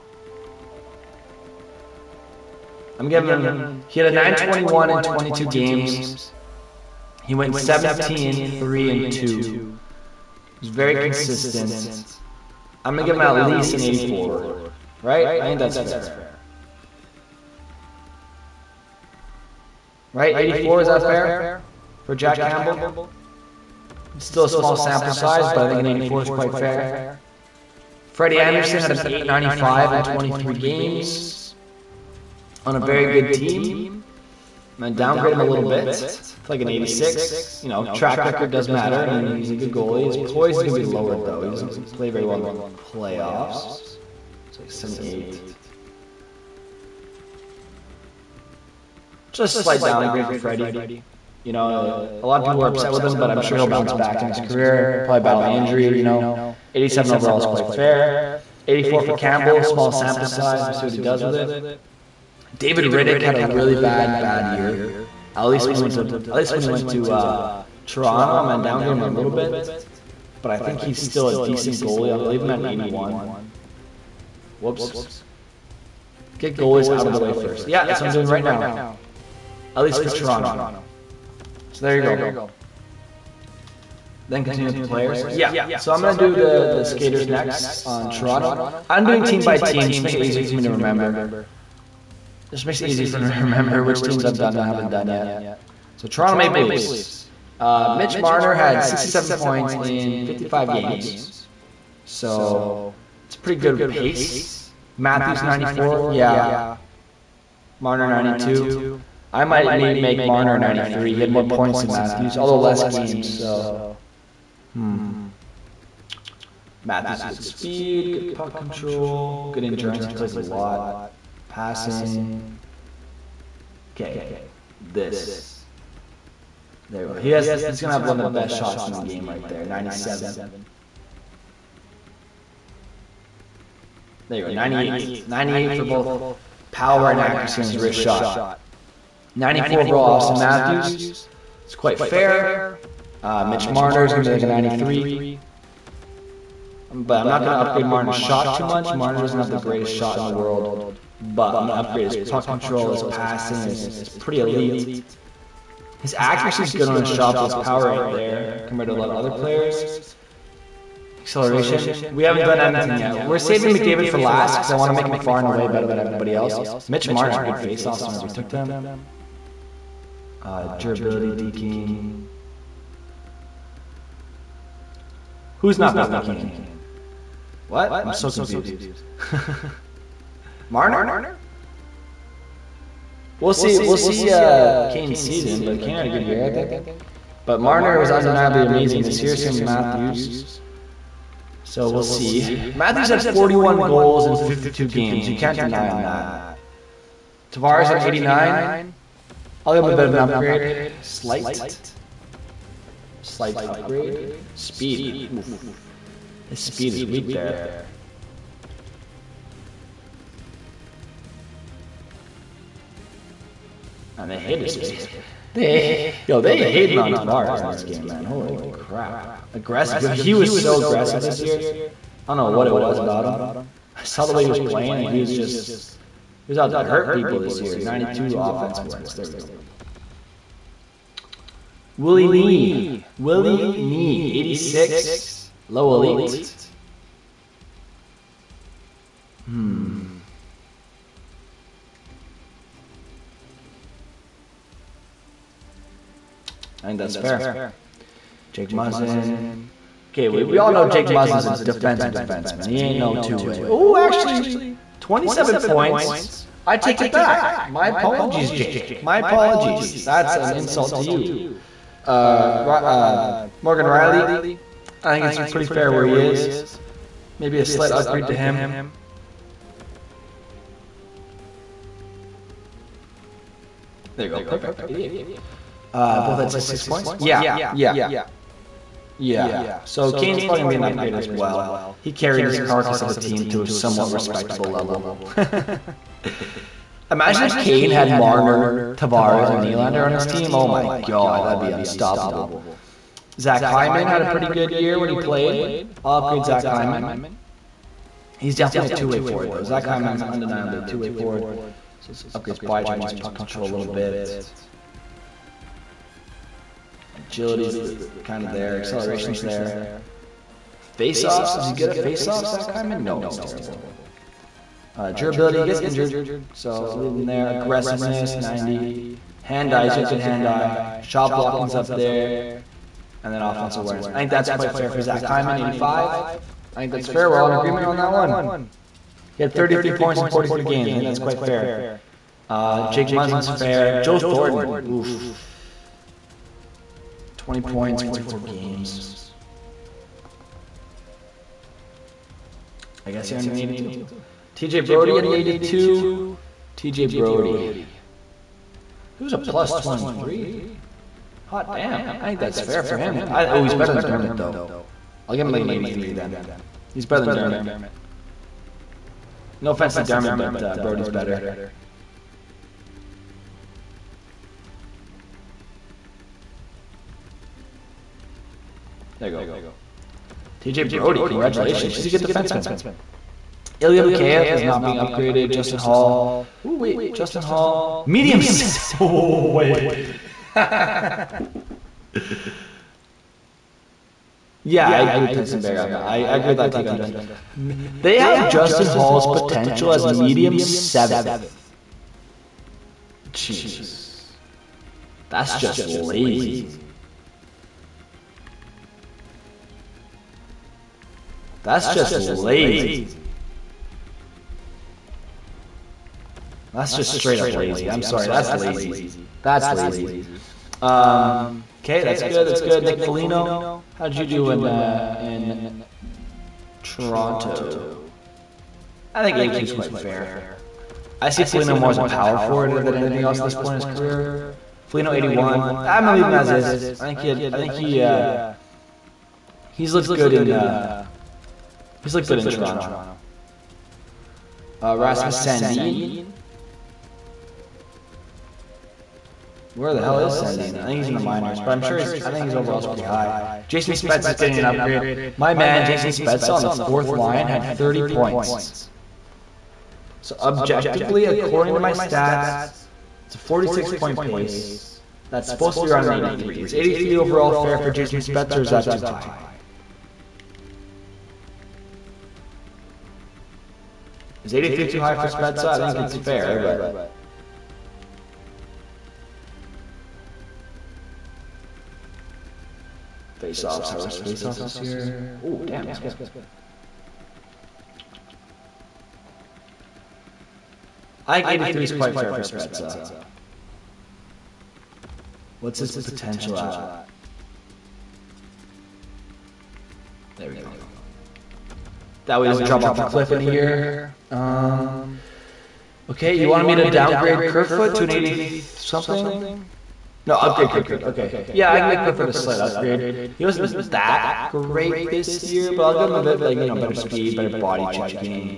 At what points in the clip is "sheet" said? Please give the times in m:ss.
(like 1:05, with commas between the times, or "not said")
not said.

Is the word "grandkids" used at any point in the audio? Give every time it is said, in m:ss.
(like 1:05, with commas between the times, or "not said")
not said.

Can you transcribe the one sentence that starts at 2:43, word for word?
We're saving McDavid for last because I want to make him far and away better than everybody else.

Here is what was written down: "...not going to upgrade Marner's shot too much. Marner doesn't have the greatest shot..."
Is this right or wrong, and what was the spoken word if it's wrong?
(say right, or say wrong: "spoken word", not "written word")
right.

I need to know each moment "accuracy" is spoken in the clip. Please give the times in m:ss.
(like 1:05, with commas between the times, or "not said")
2:17, 2:36.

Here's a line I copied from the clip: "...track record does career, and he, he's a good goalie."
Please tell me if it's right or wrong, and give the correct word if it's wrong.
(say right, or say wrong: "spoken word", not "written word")
wrong: "matter", not "career".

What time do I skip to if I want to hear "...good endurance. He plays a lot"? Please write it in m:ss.
1:59.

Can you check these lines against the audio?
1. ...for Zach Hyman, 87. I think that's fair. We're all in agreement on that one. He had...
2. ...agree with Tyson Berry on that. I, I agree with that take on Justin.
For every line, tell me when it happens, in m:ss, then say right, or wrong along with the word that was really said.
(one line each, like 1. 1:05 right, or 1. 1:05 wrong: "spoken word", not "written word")
1. 5:24 wrong: "85", not "87"
2. 6:24 right.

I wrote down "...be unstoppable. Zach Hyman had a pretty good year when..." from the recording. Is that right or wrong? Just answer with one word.
right.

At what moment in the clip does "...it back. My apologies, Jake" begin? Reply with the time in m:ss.
4:17.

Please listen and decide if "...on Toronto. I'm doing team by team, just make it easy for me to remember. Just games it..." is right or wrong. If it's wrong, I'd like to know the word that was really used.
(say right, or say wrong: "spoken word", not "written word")
wrong: "makes", not "games".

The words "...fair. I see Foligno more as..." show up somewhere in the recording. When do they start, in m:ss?
6:59.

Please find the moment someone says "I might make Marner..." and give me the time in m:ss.
1:49.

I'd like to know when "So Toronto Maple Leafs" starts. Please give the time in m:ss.
1:35.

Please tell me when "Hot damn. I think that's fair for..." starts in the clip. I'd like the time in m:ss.
5:51.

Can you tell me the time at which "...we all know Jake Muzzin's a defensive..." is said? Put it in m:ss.
4:10.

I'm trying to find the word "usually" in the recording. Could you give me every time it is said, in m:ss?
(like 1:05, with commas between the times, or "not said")
not said.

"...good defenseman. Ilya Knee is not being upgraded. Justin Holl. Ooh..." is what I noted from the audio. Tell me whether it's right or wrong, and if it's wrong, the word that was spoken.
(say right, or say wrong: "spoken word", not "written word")
wrong: "Mikheyev", not "Knee".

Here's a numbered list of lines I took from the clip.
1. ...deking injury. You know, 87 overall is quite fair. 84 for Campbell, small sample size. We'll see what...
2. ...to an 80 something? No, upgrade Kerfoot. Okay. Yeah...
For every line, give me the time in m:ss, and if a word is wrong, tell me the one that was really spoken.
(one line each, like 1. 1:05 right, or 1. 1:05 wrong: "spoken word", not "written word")
1. 0:55 wrong: "battling", not "deking"
2. 8:17 right.